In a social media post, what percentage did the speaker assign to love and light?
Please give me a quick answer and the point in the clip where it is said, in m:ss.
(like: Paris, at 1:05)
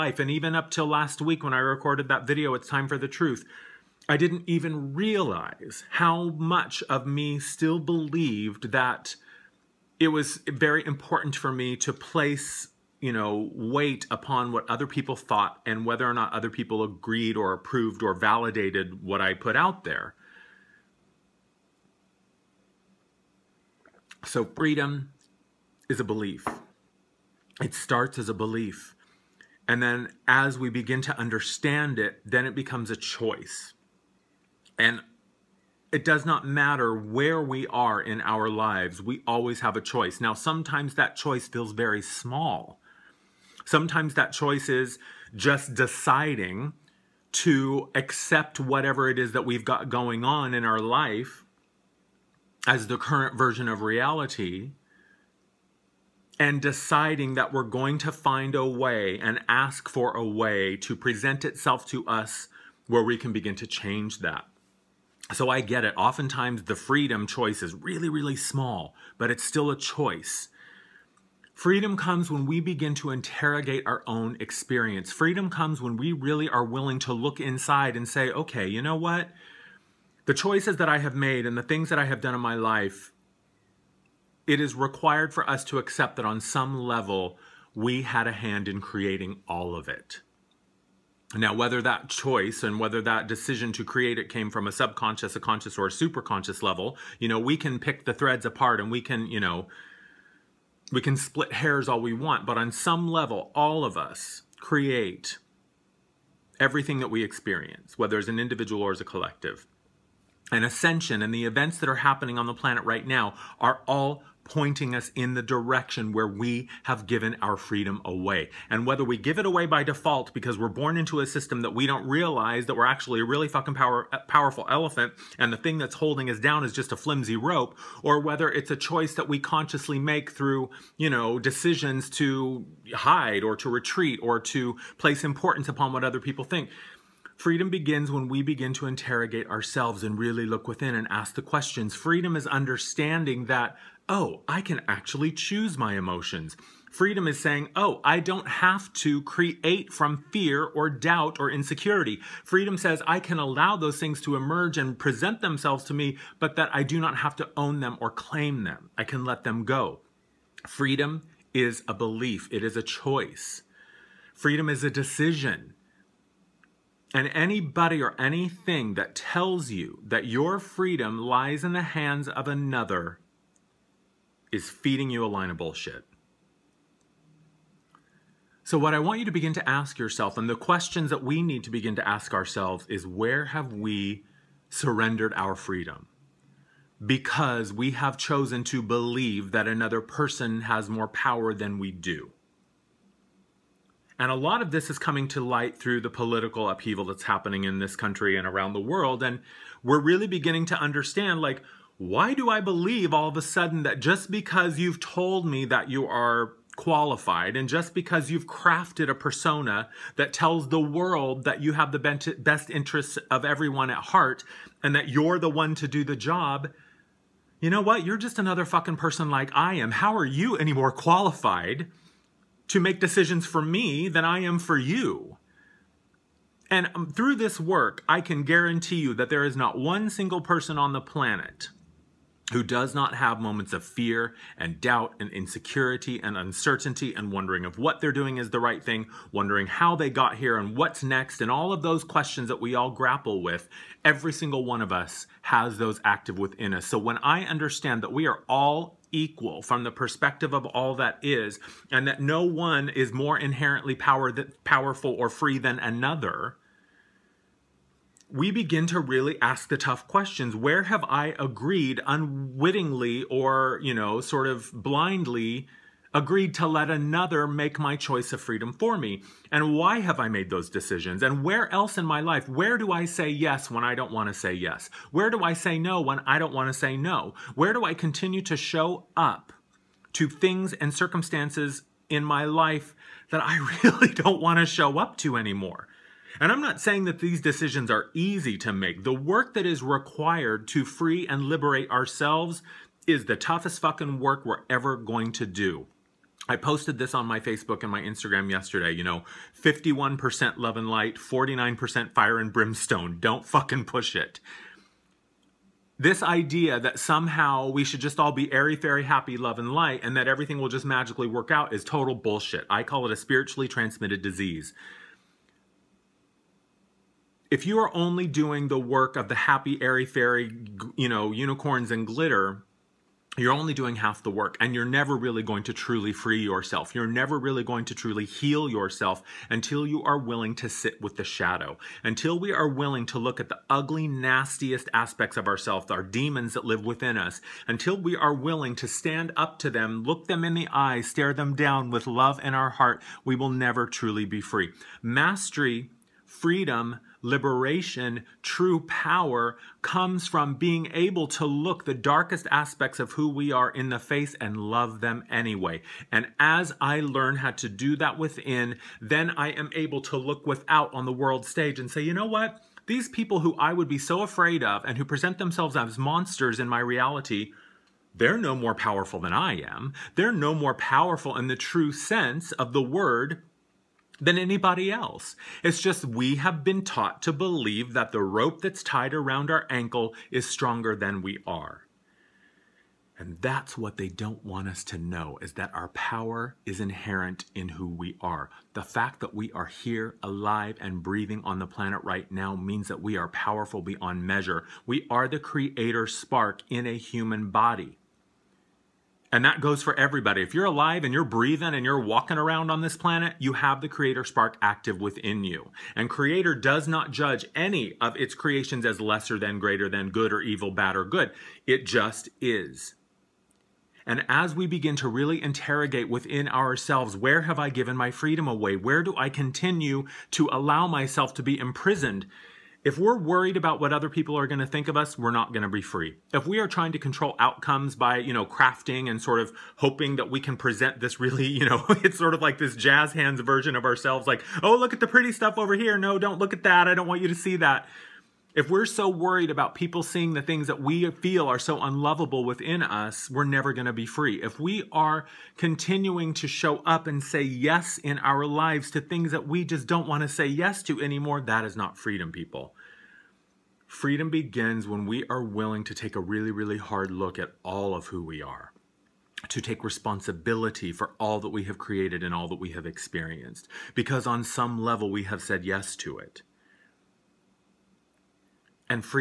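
51%, at 4:59.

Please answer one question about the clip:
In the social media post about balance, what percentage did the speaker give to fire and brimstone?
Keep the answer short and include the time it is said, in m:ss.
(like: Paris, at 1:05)
49%, at 5:01.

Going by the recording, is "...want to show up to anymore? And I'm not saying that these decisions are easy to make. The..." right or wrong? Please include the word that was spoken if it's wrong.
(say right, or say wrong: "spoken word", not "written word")
right.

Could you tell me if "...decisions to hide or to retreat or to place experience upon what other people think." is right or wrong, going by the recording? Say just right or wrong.
wrong.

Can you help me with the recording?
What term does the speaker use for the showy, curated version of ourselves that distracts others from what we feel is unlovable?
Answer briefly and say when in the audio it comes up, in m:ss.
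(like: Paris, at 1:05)
jazz hands version, at 7:12.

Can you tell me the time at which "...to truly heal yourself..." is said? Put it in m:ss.
5:27.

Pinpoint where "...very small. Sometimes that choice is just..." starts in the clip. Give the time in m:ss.
0:41.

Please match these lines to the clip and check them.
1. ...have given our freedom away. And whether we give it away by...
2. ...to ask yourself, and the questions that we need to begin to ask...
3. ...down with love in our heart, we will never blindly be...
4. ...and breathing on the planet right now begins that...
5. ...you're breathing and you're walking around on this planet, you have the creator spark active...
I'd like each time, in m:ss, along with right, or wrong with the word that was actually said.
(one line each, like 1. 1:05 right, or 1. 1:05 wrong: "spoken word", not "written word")
1. 1:56 right
2. 2:59 right
3. 5:41 wrong: "truly", not "blindly"
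4. 6:30 wrong: "means", not "begins"
5. 6:41 right.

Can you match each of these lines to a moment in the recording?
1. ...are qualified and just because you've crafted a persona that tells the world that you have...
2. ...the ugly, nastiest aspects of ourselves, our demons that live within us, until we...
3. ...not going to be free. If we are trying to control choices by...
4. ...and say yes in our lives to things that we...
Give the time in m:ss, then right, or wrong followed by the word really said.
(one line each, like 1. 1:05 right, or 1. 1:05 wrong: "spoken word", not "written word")
1. 3:26 right
2. 5:33 right
3. 7:05 wrong: "outcomes", not "choices"
4. 7:27 right.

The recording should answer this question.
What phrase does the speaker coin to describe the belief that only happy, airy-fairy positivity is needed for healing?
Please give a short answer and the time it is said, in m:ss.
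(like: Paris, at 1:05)
spiritually transmitted disease, at 5:13.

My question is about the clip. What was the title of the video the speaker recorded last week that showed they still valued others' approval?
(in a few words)
It's Time for the Truth.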